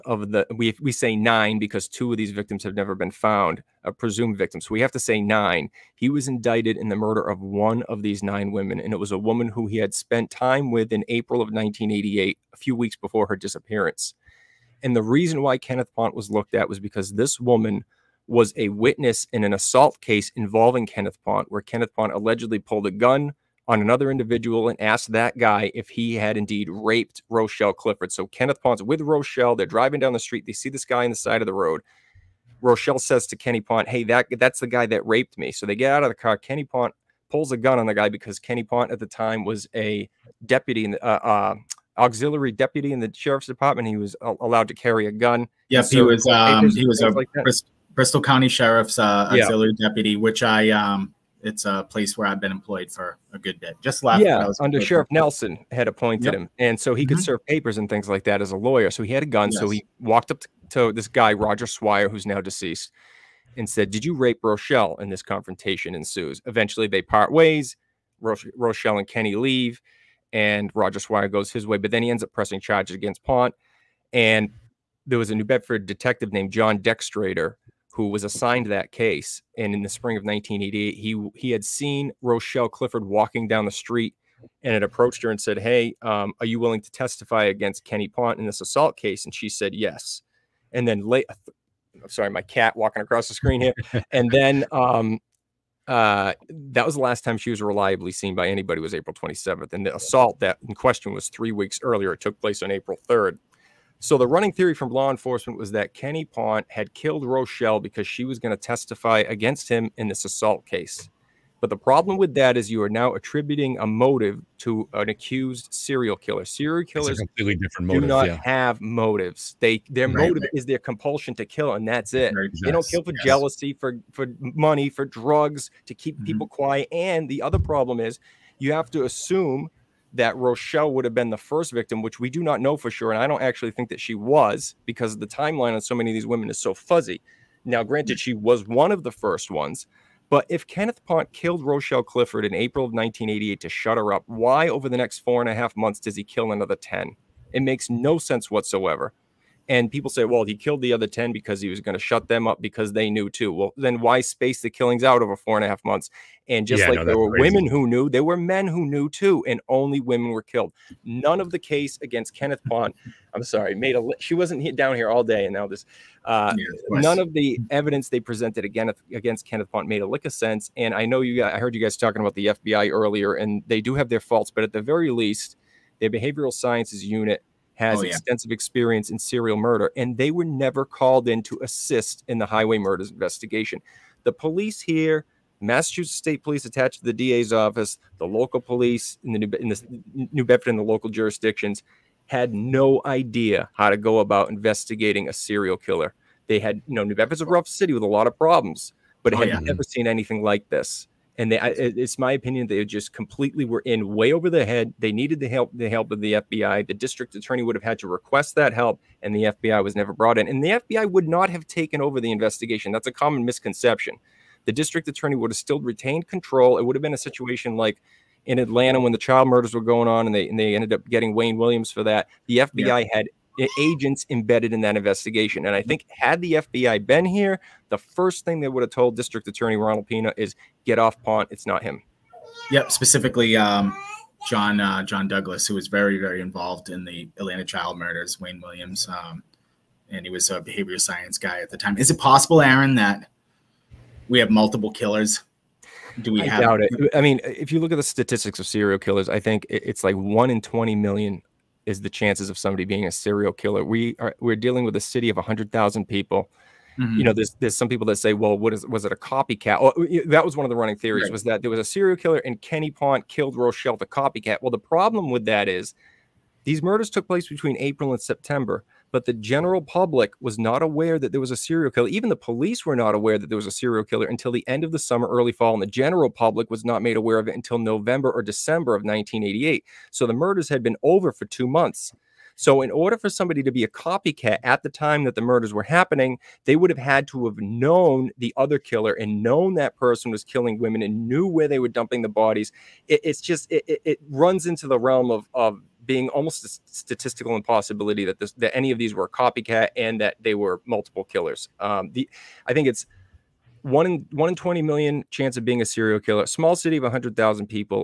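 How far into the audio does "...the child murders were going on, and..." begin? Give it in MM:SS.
03:39.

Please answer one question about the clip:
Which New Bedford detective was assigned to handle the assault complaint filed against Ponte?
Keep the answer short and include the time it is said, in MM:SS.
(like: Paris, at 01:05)
John Dextradeur, at 01:16.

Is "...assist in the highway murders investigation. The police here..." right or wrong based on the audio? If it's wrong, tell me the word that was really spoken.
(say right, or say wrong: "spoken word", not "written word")
right.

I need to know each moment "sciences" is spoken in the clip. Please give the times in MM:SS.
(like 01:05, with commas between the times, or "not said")
02:56, 04:00.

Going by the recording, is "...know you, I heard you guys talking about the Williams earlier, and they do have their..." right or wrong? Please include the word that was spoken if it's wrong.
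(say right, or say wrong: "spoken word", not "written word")
wrong: "FBI", not "Williams".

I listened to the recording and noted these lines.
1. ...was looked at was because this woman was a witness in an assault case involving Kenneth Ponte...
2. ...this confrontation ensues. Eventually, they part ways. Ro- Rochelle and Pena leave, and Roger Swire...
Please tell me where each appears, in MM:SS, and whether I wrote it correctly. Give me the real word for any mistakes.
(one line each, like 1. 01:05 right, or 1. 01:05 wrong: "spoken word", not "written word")
1. 00:16 right
2. 01:05 wrong: "Kenny", not "Pena".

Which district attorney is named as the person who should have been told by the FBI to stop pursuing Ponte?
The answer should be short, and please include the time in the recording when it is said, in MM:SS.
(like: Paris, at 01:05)
Ronald Pena, at 03:49.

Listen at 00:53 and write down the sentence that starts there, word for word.
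Just last yeah, under Sheriff Nelson had appointed yep.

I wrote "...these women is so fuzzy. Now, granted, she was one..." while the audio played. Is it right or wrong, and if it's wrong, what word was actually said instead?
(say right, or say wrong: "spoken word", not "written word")
right.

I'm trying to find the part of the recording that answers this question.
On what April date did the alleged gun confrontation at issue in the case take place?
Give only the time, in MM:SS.
01:42.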